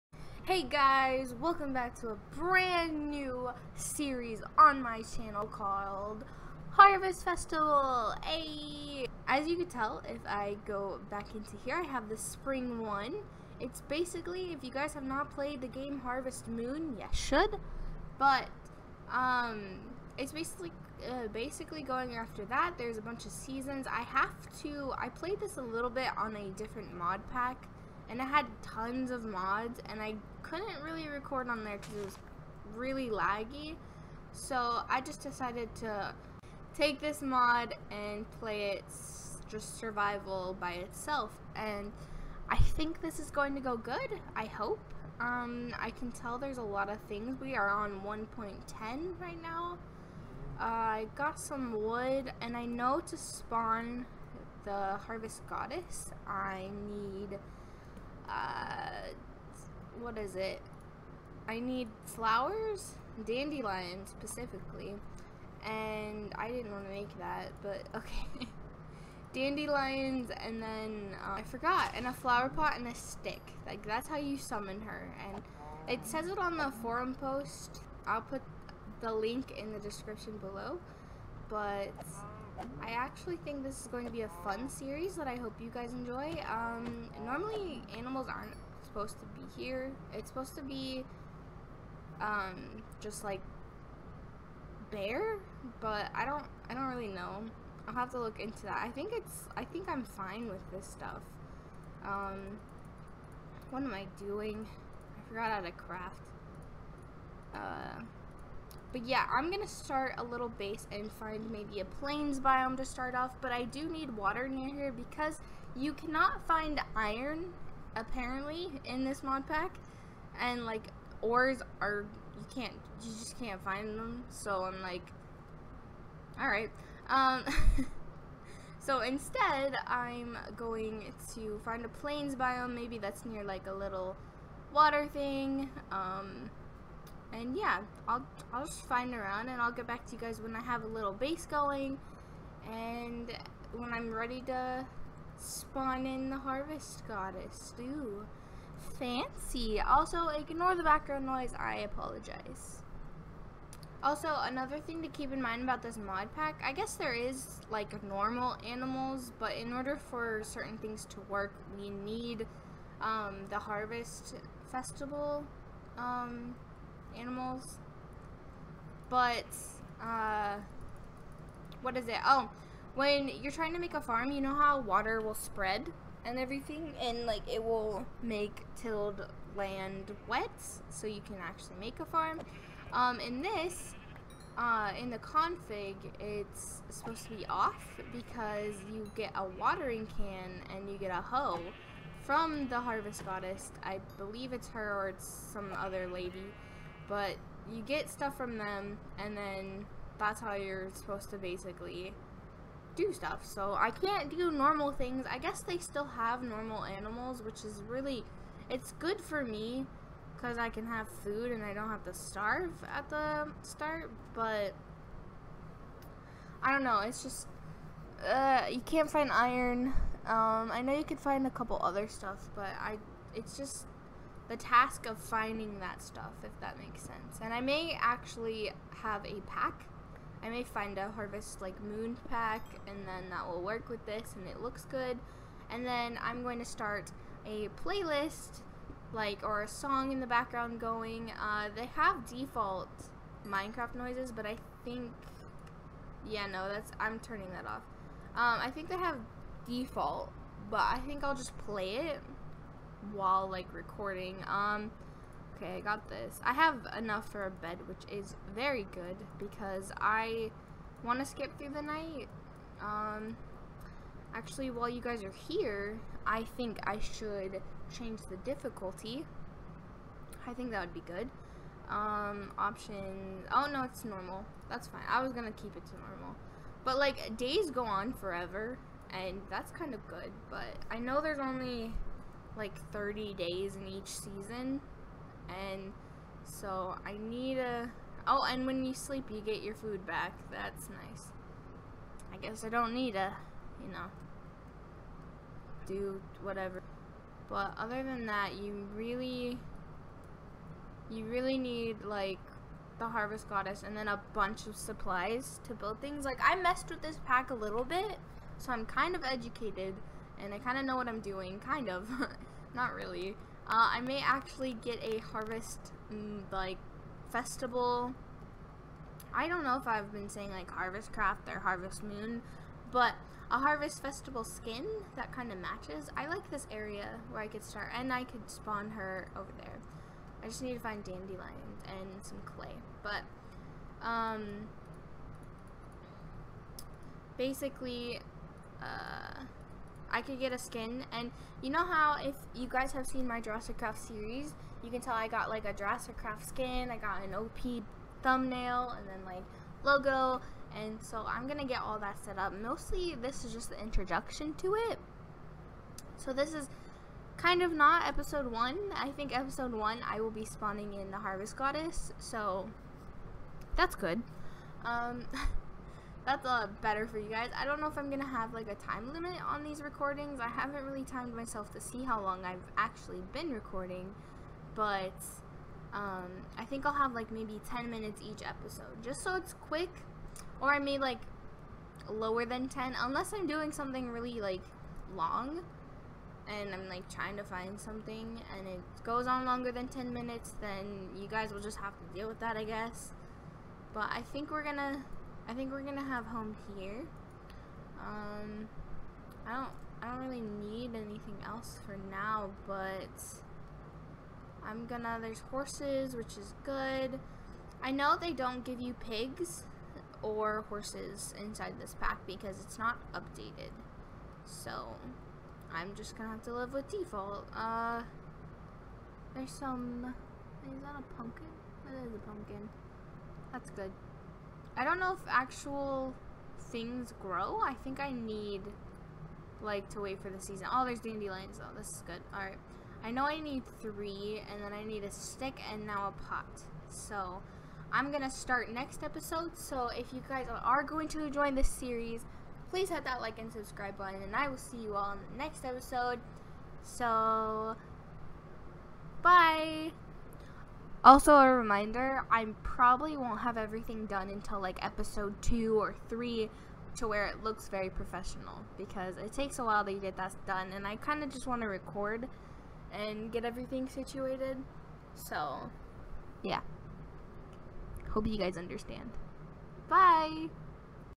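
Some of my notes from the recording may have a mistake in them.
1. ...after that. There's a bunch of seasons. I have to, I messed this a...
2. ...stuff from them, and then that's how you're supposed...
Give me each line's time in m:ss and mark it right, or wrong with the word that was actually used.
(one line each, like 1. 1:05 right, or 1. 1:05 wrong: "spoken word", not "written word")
1. 0:22 wrong: "played", not "messed"
2. 3:18 right.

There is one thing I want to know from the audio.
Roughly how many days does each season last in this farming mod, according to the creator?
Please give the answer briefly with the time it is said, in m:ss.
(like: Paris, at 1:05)
30, at 4:42.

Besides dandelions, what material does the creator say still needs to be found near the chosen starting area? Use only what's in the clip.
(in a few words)
Clay.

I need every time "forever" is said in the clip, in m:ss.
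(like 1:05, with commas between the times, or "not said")
4:38.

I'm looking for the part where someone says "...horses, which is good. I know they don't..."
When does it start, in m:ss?
6:45.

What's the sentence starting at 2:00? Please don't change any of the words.
And like, ores are, you can't, you just can't find them.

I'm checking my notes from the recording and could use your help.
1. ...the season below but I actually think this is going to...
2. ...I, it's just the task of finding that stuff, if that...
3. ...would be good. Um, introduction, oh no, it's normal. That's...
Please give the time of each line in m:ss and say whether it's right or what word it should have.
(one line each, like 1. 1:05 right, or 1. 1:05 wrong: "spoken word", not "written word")
1. 1:19 wrong: "description", not "season"
2. 3:42 right
3. 4:30 wrong: "option", not "introduction".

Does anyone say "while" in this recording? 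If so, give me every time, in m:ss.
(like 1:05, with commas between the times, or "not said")
4:13, 4:24, 7:39.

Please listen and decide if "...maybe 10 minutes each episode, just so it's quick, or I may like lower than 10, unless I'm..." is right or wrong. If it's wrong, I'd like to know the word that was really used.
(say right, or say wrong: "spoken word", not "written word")
right.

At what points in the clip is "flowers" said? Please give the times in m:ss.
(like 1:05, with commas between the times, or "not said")
1:02, 1:12.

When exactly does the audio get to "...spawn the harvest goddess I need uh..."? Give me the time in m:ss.
0:53.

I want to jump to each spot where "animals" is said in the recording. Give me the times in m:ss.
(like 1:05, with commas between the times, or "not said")
1:27, 2:38, 2:47, 3:26.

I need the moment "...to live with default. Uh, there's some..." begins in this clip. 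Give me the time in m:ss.
6:56.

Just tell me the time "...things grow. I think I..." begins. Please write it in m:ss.
7:06.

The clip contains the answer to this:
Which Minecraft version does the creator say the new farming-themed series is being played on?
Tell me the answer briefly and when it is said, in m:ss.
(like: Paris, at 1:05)
1.10, at 0:48.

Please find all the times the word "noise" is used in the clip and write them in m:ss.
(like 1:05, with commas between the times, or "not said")
2:31, 4:03.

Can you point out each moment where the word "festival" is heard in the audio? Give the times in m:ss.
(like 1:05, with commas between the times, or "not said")
0:07, 2:44, 5:17, 5:24.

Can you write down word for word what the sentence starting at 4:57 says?
But other than that, you really, you really need, like, the Harvest Goddess and then a bunch of supplies to build things.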